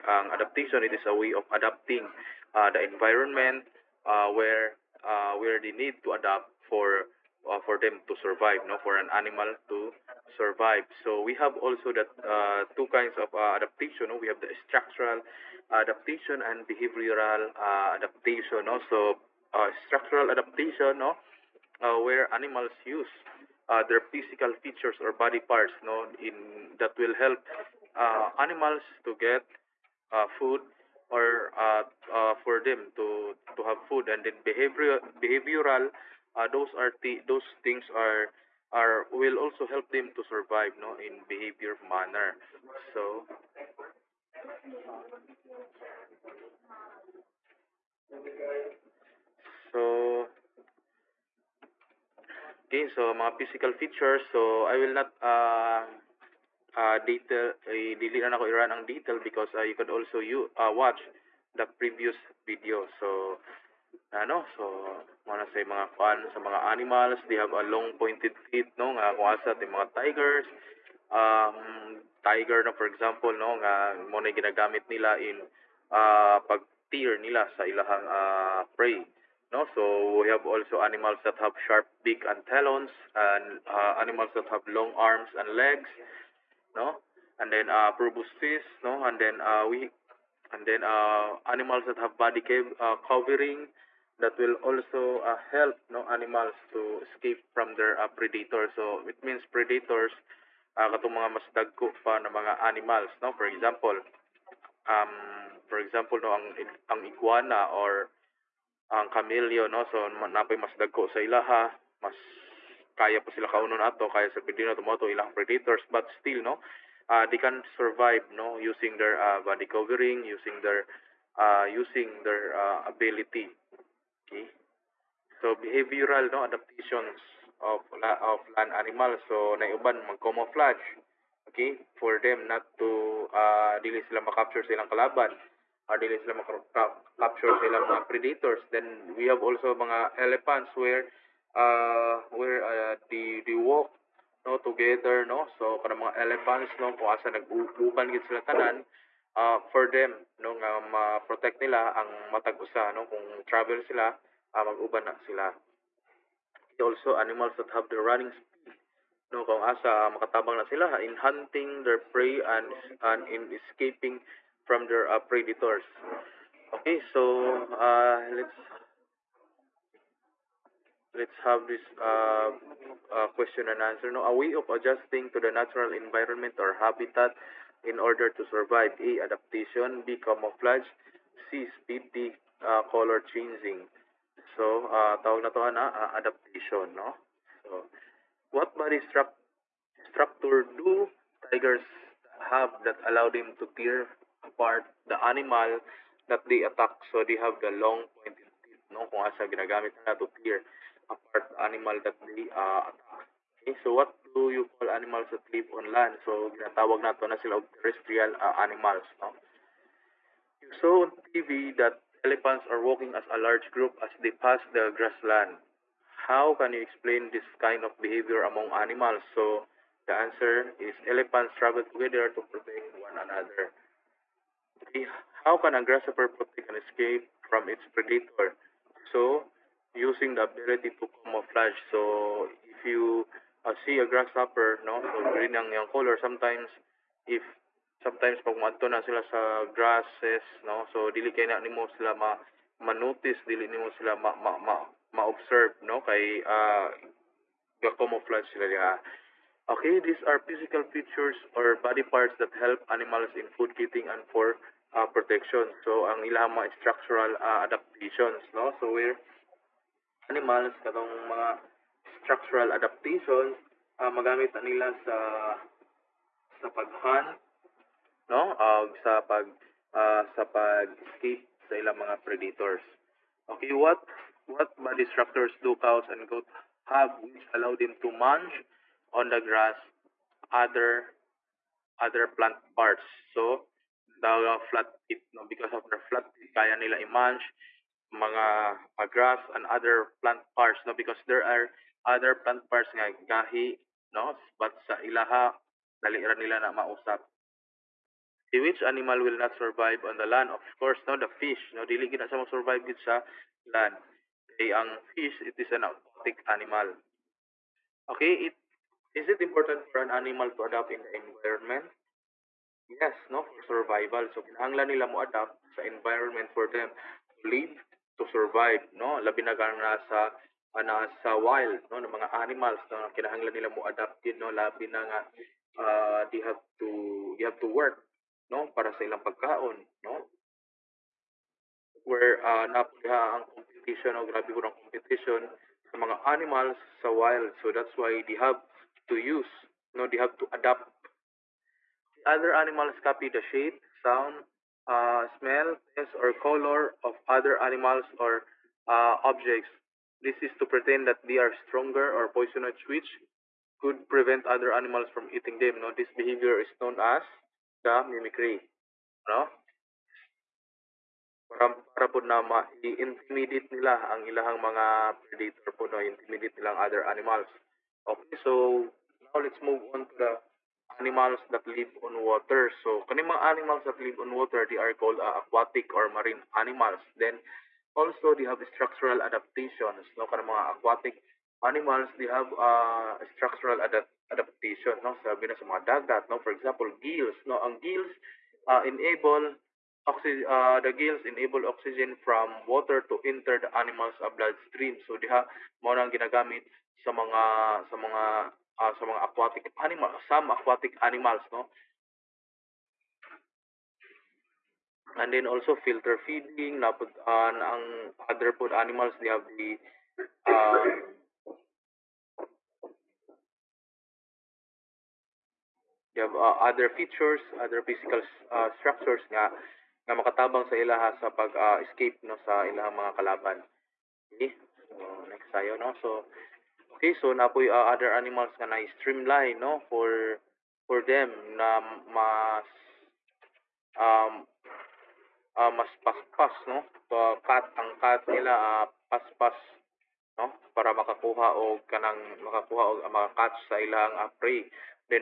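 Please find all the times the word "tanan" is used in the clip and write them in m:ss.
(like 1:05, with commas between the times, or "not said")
2:28.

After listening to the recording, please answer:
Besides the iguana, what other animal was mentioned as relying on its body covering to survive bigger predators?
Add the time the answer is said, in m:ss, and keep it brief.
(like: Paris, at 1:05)
Camellia, at 1:49.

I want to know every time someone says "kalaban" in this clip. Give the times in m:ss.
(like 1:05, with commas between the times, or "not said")
2:14, 7:03.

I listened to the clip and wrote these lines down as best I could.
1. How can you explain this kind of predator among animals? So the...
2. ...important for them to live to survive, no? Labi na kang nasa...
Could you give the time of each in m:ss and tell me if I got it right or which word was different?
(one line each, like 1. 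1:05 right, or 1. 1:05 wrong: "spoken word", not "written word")
1. 3:36 wrong: "behavior", not "predator"
2. 5:15 wrong: "environment", not "important".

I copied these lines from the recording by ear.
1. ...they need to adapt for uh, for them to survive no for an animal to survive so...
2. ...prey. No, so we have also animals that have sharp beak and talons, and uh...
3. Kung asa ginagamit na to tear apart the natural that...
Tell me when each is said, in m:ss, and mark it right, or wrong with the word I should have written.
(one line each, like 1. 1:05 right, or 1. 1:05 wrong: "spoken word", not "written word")
1. 0:05 right
2. 1:18 right
3. 3:19 wrong: "animal", not "natural".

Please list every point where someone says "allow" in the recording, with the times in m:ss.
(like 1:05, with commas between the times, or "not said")
3:13, 4:37.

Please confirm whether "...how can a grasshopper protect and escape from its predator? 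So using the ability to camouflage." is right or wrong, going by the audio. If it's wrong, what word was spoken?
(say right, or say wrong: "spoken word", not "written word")
right.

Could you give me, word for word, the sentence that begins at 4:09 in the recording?
Okay, these are physical features or body parts that help animals in food kitting and for uh, protection.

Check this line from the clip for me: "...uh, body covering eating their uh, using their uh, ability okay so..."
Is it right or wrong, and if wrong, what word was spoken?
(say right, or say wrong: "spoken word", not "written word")
wrong: "using", not "eating".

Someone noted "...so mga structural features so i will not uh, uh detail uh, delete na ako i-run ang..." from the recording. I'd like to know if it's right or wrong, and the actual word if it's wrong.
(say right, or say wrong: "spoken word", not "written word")
wrong: "physical", not "structural".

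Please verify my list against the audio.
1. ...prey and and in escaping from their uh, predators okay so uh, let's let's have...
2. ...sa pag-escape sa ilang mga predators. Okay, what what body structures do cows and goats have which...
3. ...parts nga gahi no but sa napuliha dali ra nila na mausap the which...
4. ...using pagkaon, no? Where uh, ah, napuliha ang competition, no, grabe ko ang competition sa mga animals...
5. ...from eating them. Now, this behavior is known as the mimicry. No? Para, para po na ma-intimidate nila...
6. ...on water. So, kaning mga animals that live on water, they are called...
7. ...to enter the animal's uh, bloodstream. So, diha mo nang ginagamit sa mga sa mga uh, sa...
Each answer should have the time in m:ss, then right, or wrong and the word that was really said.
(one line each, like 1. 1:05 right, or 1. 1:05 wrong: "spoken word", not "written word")
1. 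2:41 right
2. 4:30 right
3. 4:52 wrong: "ilaha", not "napuliha"
4. 5:29 wrong: "ilang", not "using"
5. 5:55 right
6. 6:12 right
7. 6:33 right.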